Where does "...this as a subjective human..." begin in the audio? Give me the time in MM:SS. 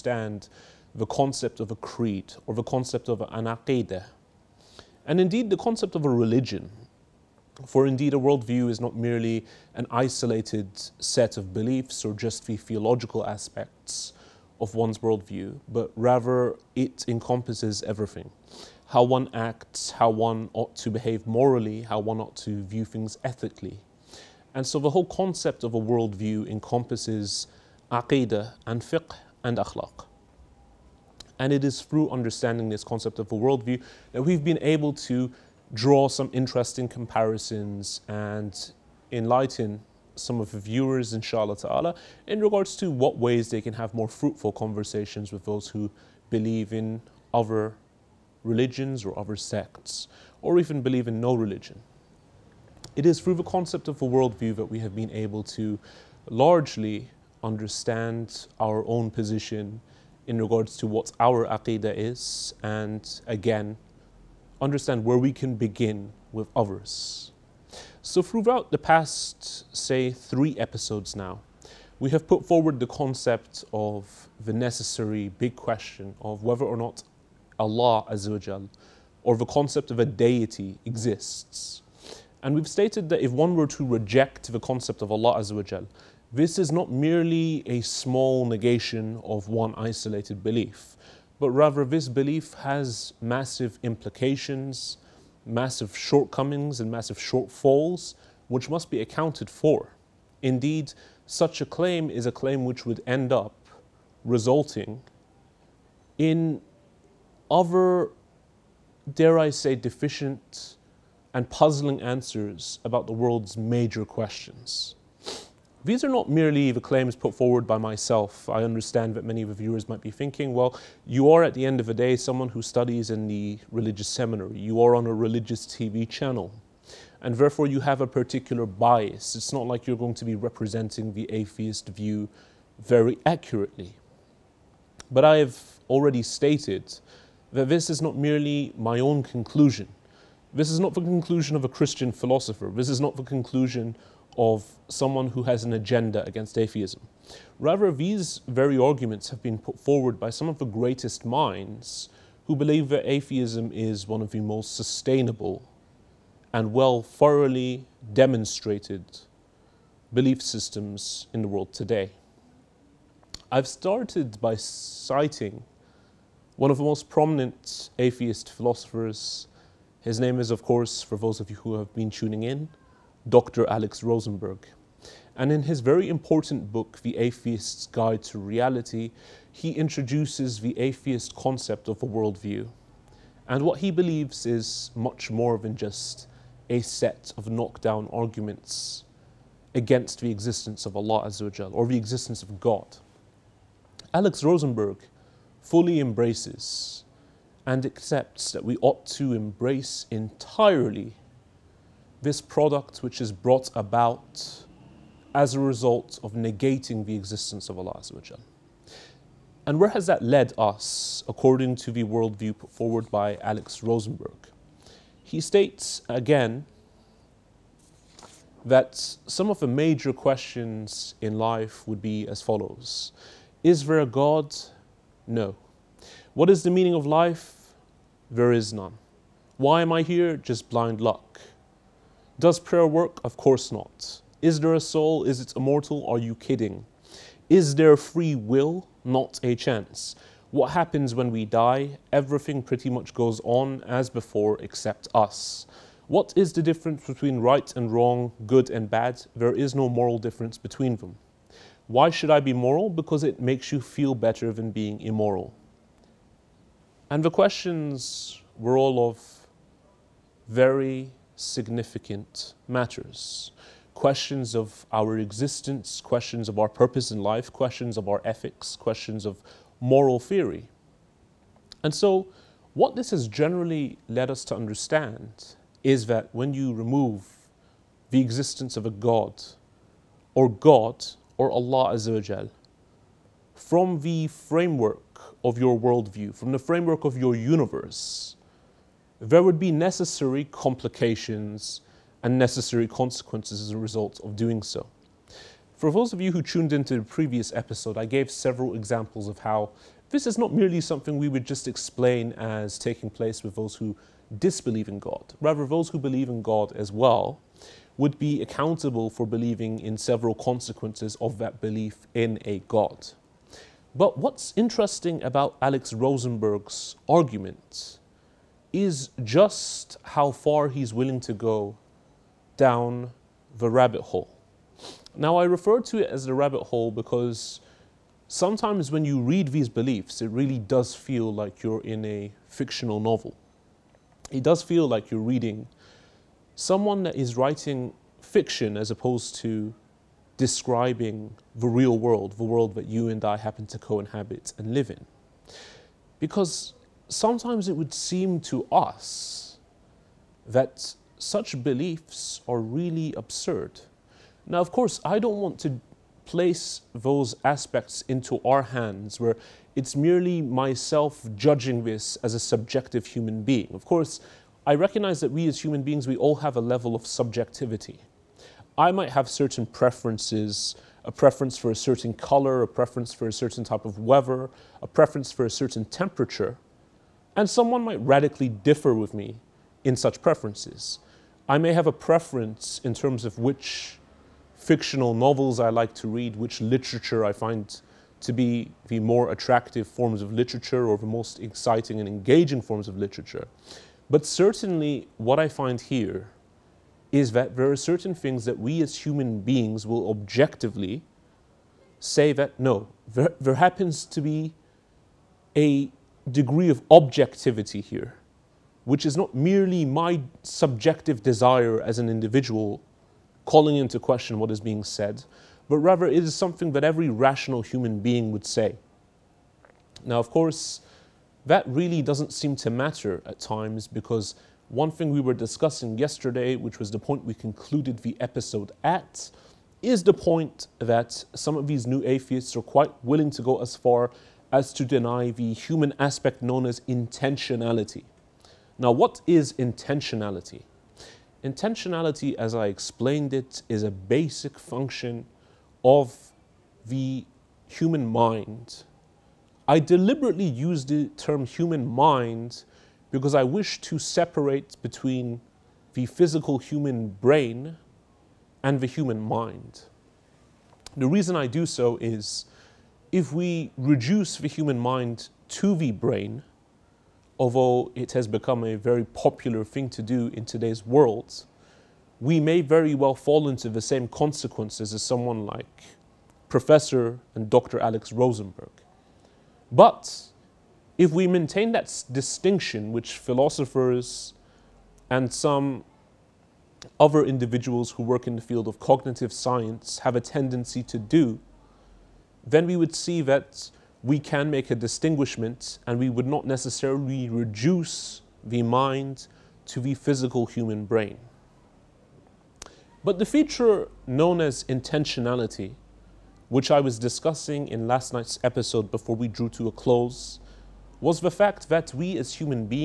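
06:01.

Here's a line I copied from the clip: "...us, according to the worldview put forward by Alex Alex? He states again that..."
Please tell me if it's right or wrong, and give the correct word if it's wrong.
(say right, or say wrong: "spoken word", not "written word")
wrong: "Rosenberg", not "Alex".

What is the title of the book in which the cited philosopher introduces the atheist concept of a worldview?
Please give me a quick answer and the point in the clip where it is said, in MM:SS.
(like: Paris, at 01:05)
The Atheist's Guide to Reality, at 02:57.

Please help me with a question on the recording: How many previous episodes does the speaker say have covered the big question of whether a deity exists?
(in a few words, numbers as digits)
3.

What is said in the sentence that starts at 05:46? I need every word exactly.
Because sometimes it would seem to us that such beliefs are really absurd.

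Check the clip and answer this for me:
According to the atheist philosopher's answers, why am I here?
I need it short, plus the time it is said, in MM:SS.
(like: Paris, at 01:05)
Just blind luck, at 03:50.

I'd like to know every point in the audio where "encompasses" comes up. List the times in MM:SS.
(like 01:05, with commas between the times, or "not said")
00:17, 00:26.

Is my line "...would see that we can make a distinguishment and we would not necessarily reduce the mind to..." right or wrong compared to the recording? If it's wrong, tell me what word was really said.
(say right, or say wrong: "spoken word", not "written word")
right.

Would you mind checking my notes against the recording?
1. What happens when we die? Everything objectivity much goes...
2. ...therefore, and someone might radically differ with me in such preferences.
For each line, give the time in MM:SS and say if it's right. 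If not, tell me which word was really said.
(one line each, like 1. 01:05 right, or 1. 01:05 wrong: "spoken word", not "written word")
1. 04:00 wrong: "pretty", not "objectivity"
2. 06:15 wrong: "temperature", not "therefore".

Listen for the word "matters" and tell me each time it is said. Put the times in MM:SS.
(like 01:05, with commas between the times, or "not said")
04:22, 07:02.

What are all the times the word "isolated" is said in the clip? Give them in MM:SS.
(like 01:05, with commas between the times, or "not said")
00:09, 01:29.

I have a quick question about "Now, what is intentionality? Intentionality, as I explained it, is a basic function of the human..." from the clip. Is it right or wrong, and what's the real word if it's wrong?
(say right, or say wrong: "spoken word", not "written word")
right.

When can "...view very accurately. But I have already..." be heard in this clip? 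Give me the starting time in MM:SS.
02:11.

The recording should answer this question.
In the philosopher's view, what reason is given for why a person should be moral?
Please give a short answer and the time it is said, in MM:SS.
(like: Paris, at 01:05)
It makes you feel better, at 04:13.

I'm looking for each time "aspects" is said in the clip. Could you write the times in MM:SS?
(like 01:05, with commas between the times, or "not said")
00:13, 05:57, 07:15.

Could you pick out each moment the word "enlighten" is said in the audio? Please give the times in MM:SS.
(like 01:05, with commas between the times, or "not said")
00:39.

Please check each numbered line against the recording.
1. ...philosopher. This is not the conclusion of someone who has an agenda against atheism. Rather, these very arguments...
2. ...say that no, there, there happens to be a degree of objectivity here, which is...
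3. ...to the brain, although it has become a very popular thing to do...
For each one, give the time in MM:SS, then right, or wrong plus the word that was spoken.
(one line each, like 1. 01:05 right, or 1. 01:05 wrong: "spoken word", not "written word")
1. 02:22 right
2. 06:41 right
3. 07:45 right.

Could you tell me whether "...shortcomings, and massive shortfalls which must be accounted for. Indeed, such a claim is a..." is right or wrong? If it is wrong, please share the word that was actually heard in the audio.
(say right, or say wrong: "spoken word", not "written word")
right.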